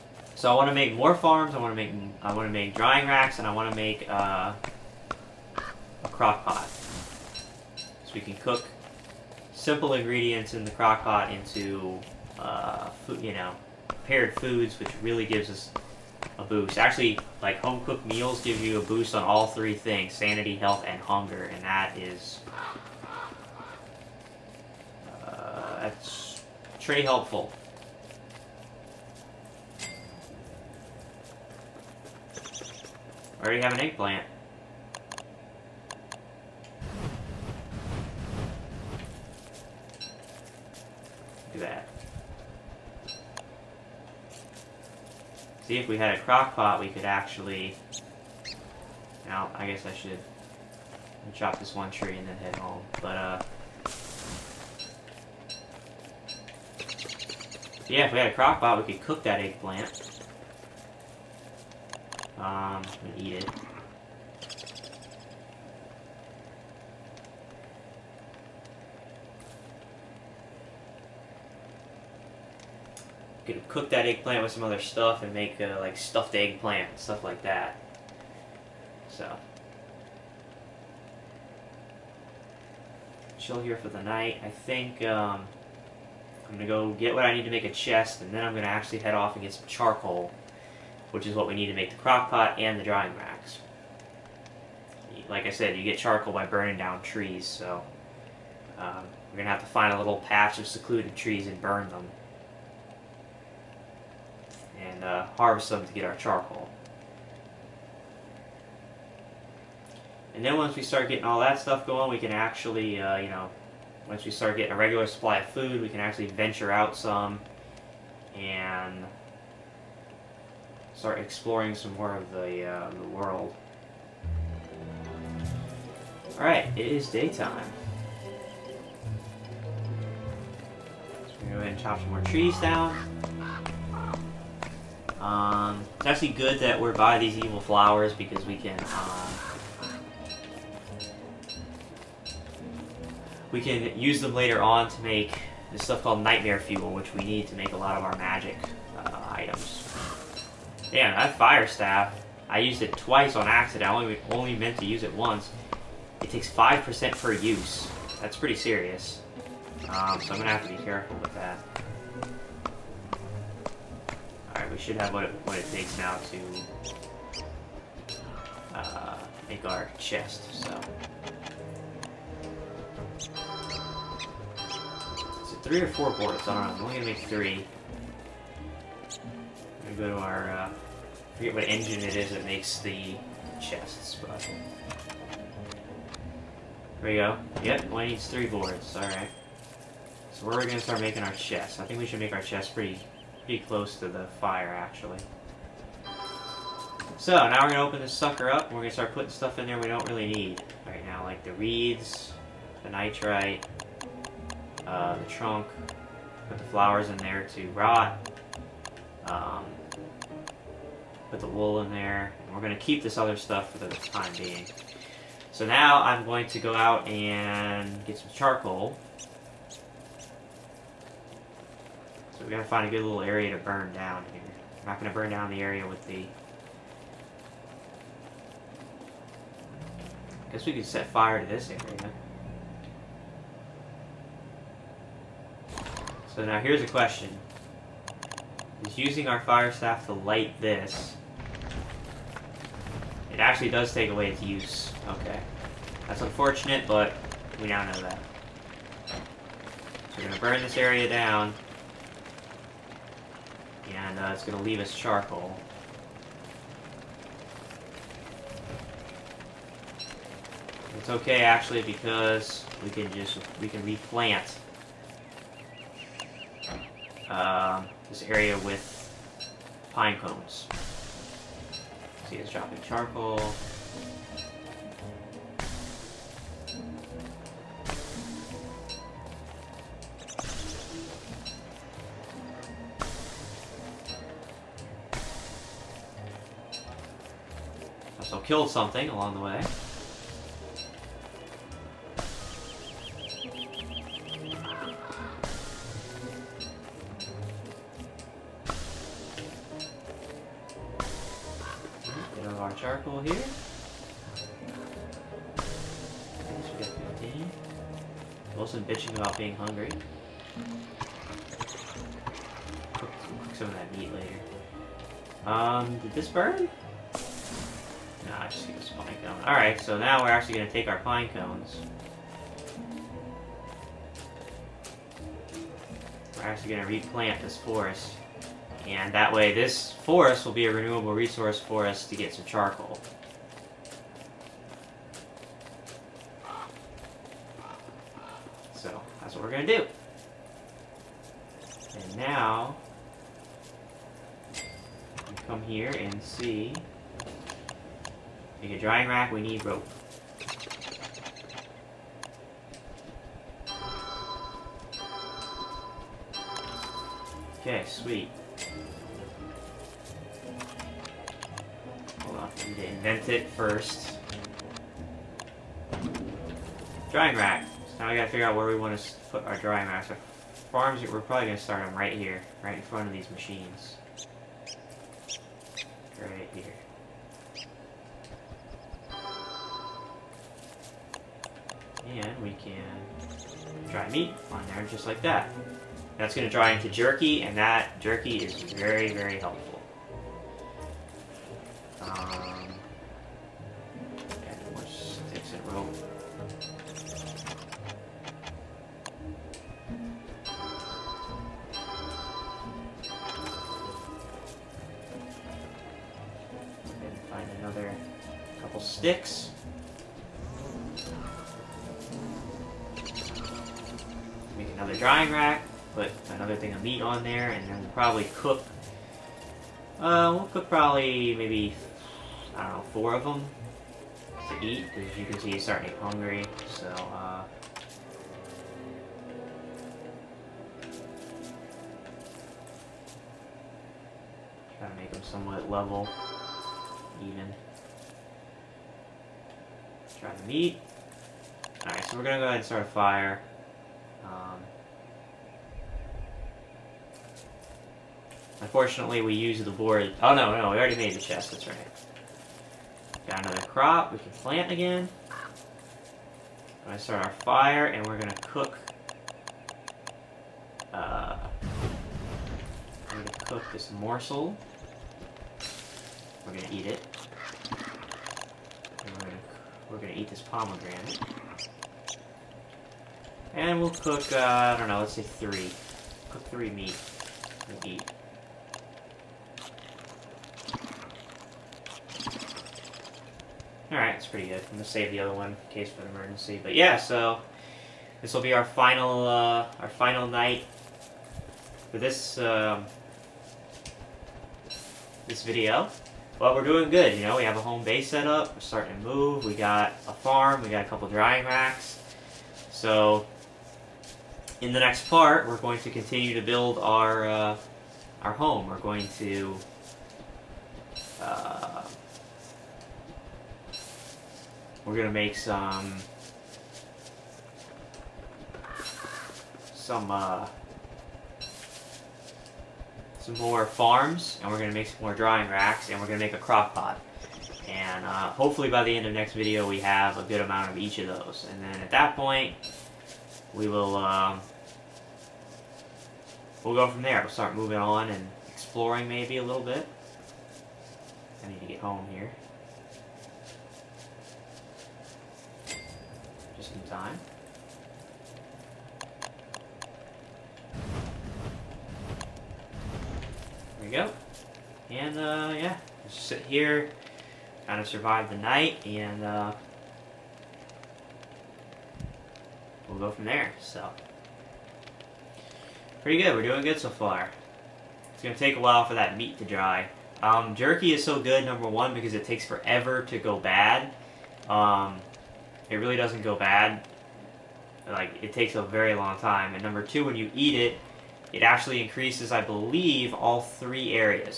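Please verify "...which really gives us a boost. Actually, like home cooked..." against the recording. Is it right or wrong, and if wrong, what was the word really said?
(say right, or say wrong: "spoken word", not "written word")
right.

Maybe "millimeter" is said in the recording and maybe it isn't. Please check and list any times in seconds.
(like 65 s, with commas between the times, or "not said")
not said.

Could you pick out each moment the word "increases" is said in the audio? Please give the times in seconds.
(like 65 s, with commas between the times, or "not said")
581 s.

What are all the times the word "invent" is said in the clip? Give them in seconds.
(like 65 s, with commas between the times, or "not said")
362 s.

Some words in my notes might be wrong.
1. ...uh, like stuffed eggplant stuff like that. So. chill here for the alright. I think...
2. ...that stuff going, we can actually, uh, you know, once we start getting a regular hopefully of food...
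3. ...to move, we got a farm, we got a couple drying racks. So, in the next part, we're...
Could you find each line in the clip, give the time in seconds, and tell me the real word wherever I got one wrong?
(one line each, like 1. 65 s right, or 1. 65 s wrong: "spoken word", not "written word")
1. 75 s wrong: "night", not "alright"
2. 111 s wrong: "supply", not "hopefully"
3. 499 s right.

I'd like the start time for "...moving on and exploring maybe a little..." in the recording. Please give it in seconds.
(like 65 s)
537 s.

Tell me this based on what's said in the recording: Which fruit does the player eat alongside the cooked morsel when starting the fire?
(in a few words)
Pomegranate.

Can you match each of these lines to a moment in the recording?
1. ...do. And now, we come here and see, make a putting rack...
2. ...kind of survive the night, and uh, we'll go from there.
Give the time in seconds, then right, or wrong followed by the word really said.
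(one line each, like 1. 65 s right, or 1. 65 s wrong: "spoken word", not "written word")
1. 339 s wrong: "drying", not "putting"
2. 557 s right.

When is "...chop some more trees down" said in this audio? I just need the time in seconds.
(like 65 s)
131 s.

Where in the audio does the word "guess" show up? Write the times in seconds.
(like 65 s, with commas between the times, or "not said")
49 s, 230 s.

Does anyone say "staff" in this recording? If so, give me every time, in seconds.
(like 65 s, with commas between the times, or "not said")
151 s, 239 s.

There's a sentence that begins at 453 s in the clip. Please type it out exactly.
Got another crop, we can plant again.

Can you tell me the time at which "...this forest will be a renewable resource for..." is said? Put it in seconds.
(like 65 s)
329 s.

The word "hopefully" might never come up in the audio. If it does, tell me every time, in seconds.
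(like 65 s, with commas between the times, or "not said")
528 s.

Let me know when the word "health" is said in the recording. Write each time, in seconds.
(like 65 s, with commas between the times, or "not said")
20 s.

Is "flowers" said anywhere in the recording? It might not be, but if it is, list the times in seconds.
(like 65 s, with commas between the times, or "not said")
137 s, 206 s.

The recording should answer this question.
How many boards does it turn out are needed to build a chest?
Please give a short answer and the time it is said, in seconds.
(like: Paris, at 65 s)
3, at 188 s.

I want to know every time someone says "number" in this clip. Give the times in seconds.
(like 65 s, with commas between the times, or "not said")
571 s, 579 s.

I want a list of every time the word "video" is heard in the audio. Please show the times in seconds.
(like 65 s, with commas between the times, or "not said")
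495 s, 529 s.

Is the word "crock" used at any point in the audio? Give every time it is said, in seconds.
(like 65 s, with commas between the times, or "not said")
6 s, 10 s, 46 s, 58 s, 91 s, 526 s.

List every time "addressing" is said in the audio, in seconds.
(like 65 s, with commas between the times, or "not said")
not said.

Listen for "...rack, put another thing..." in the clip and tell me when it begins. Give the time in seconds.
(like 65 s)
415 s.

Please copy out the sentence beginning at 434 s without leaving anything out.
Try to make him somewhat level.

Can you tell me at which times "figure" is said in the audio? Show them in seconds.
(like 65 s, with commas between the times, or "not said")
368 s.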